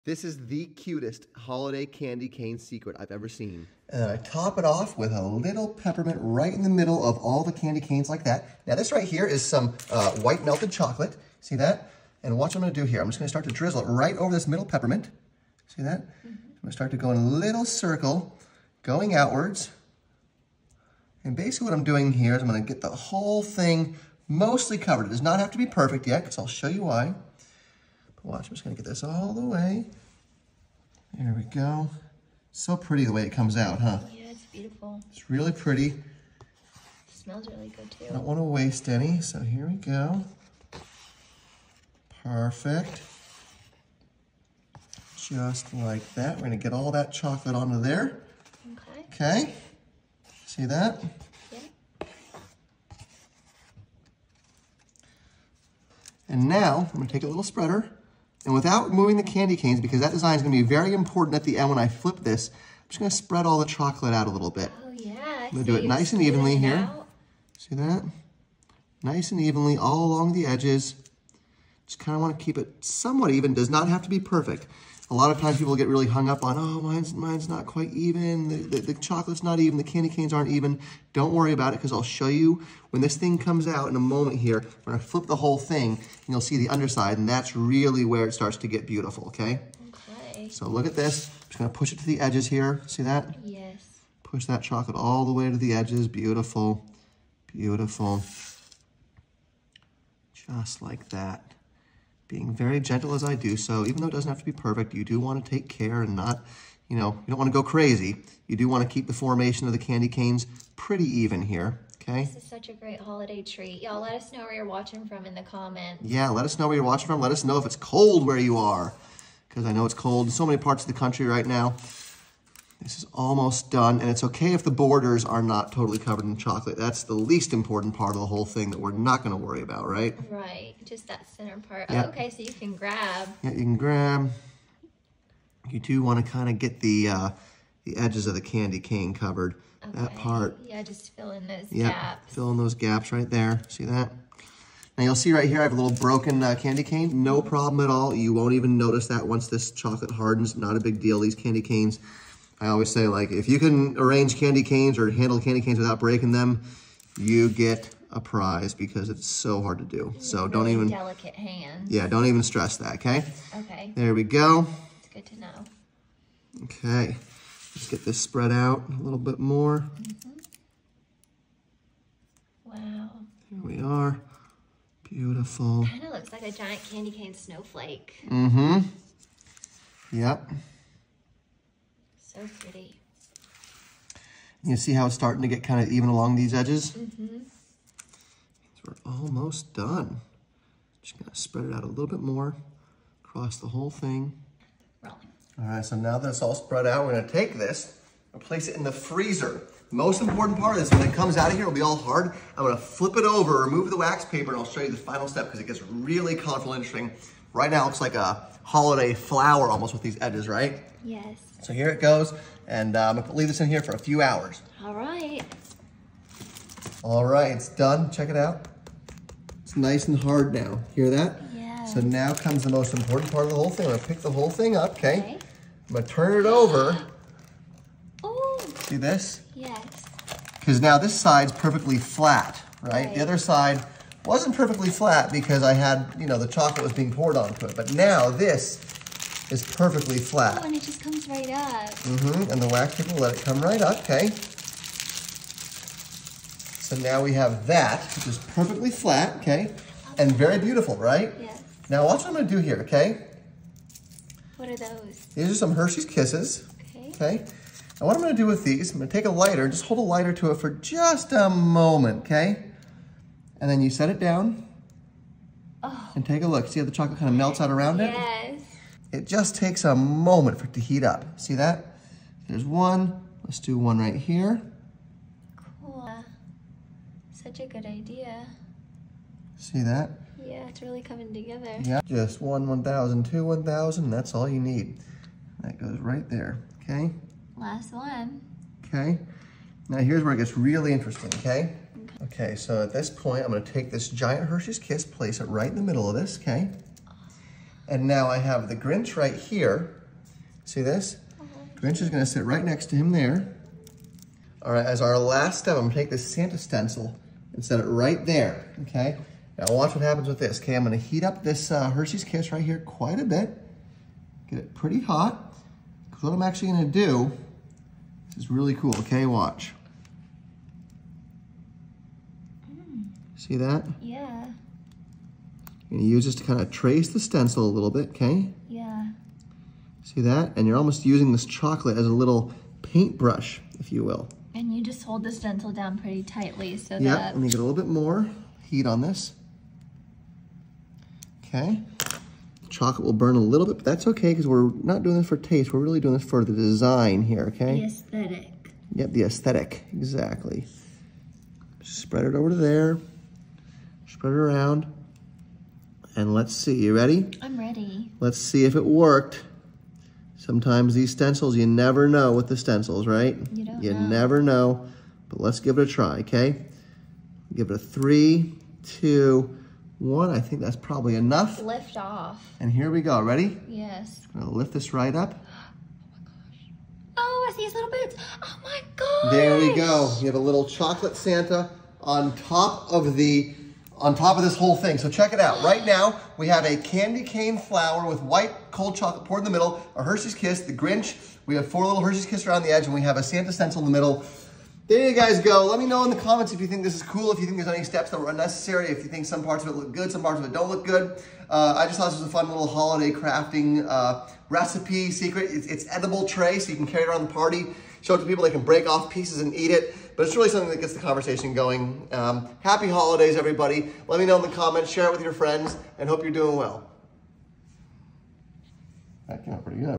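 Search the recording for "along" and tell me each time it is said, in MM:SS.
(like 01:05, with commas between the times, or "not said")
01:10, 03:06.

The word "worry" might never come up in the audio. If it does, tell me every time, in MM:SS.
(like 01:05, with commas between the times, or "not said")
01:21, 02:09.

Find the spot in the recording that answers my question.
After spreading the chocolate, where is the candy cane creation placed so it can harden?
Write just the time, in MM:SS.
03:18.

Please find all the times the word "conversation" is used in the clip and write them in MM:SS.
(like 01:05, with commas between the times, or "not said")
06:50.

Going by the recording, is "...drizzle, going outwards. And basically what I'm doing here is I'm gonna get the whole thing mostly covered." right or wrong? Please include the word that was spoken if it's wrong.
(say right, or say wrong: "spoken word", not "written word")
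wrong: "circle", not "drizzle".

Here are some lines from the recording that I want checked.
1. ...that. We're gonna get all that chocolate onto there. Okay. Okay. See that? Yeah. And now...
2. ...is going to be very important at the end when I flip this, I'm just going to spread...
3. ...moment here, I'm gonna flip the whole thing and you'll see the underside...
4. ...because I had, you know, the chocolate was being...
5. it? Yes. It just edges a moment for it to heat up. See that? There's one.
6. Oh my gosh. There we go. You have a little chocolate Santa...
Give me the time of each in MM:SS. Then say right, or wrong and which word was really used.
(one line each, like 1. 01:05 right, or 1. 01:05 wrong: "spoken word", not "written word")
1. 00:46 right
2. 01:00 right
3. 01:24 right
4. 03:55 right
5. 04:28 wrong: "takes", not "edges"
6. 06:18 right.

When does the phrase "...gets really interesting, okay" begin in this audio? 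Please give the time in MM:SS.
04:50.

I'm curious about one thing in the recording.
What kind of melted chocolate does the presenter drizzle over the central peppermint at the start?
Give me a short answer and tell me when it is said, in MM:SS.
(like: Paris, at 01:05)
White melted chocolate, at 00:10.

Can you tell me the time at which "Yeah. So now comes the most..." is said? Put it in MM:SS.
03:41.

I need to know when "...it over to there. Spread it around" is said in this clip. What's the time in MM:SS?
05:52.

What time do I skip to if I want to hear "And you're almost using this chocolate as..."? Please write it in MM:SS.
05:30.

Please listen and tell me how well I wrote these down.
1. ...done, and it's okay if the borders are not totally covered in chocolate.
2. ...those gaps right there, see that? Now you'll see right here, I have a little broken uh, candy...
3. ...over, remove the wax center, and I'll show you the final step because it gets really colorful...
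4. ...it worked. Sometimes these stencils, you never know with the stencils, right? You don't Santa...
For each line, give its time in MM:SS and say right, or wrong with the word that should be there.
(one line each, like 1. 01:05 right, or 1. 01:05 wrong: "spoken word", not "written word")
1. 02:03 right
2. 02:22 right
3. 03:23 wrong: "paper", not "center"
4. 05:58 wrong: "You", not "Santa".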